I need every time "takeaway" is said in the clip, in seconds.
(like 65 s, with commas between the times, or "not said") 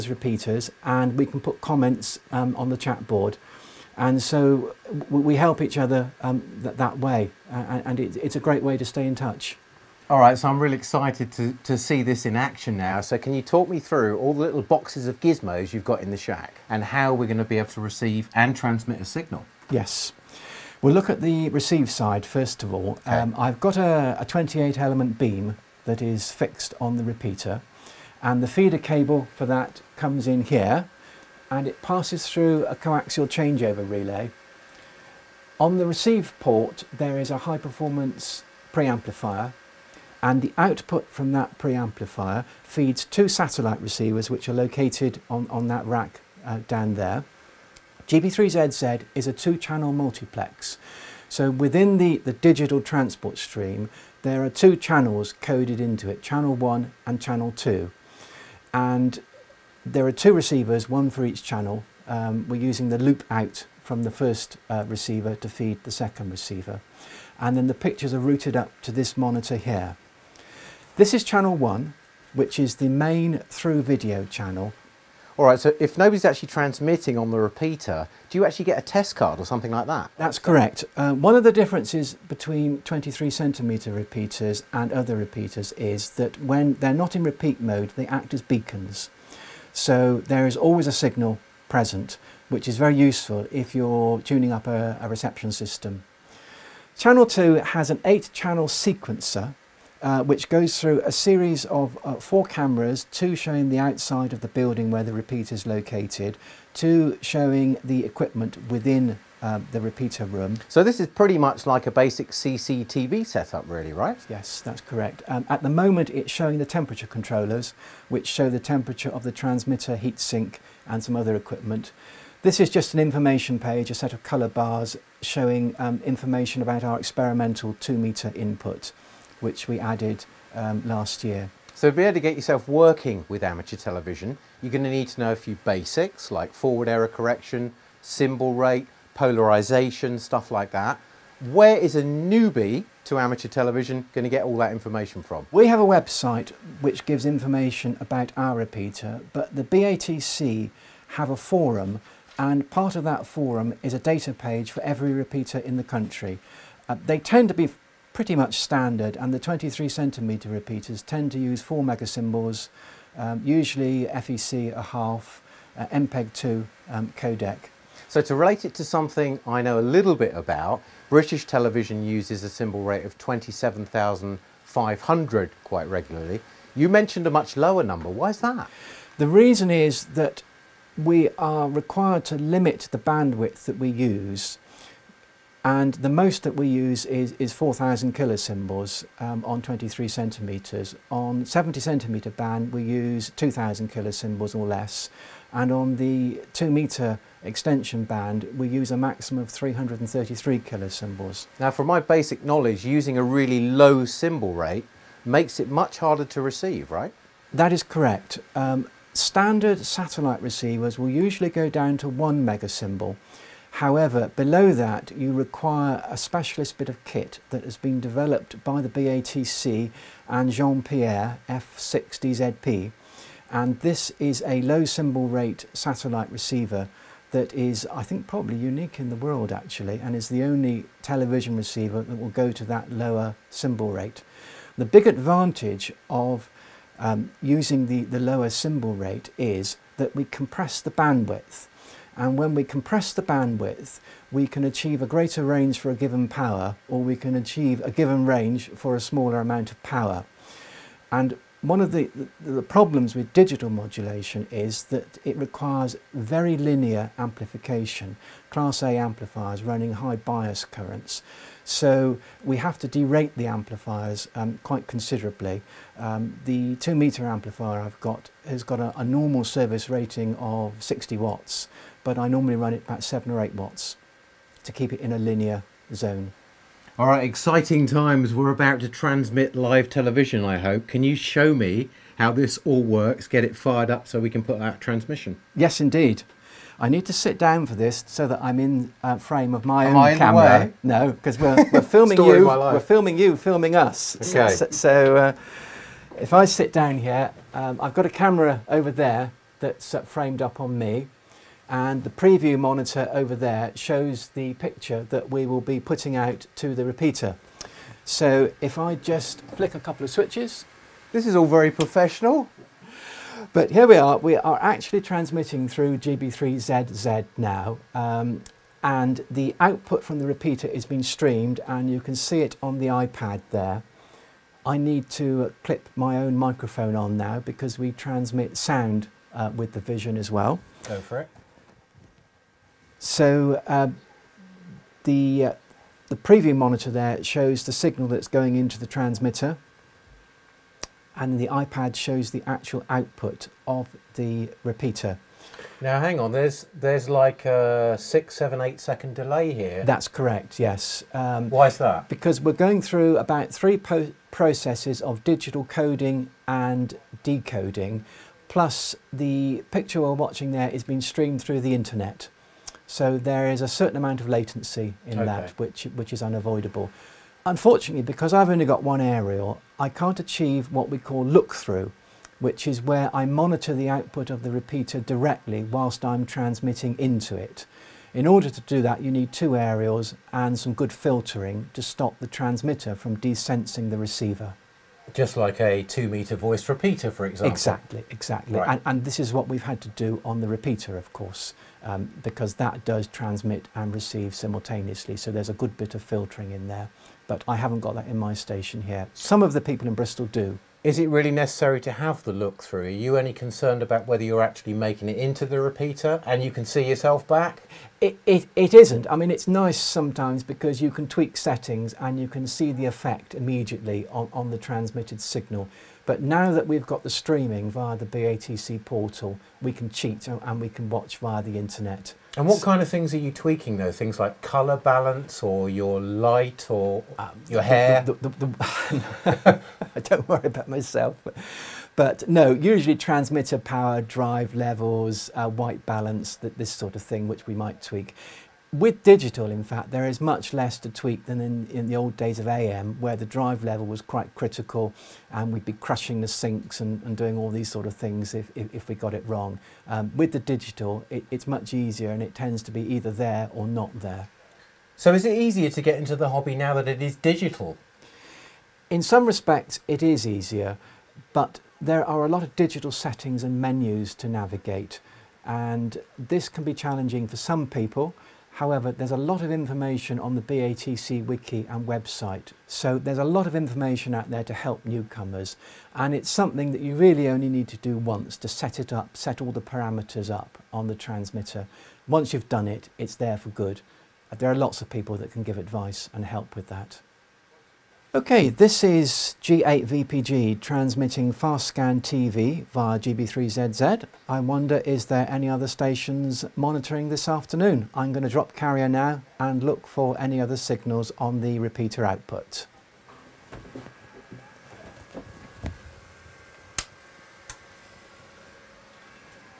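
not said.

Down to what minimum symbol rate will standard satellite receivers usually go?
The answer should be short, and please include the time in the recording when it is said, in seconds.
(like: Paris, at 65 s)
1 megasymbol, at 212 s.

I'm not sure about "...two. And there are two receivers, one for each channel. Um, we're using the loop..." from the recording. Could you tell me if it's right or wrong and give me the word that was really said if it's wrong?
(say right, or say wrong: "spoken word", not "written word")
right.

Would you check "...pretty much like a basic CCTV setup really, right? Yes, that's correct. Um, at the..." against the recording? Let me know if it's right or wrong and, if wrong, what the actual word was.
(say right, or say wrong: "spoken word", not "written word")
right.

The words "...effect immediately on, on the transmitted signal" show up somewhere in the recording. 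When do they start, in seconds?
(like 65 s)
412 s.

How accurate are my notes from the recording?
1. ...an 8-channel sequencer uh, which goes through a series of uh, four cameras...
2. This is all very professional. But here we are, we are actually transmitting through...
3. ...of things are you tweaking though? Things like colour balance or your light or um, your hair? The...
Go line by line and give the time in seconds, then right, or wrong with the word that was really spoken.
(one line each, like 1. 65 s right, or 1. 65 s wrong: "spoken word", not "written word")
1. 97 s right
2. 311 s right
3. 422 s right.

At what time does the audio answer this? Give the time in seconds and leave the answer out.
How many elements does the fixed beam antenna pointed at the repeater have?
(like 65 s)
24 s.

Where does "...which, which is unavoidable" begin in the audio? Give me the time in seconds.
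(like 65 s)
365 s.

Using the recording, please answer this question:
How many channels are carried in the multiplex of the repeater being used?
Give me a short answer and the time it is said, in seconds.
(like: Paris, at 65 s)
2, at 49 s.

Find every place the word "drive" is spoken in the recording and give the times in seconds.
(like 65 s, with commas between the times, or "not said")
434 s, 443 s.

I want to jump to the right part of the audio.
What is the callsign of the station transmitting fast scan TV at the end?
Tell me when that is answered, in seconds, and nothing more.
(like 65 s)
489 s.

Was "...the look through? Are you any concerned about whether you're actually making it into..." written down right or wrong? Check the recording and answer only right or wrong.
right.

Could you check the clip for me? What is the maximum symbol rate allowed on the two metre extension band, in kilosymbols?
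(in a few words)
333.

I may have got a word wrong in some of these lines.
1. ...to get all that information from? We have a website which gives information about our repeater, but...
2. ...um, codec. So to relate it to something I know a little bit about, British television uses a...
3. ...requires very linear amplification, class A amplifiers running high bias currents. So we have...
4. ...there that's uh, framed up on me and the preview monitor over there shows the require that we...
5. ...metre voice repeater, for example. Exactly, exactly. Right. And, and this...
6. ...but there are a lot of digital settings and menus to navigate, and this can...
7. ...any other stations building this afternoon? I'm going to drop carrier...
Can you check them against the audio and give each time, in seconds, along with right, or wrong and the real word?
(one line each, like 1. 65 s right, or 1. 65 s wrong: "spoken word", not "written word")
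1. 144 s right
2. 166 s right
3. 255 s right
4. 298 s wrong: "picture", not "require"
5. 386 s right
6. 461 s right
7. 495 s wrong: "monitoring", not "building".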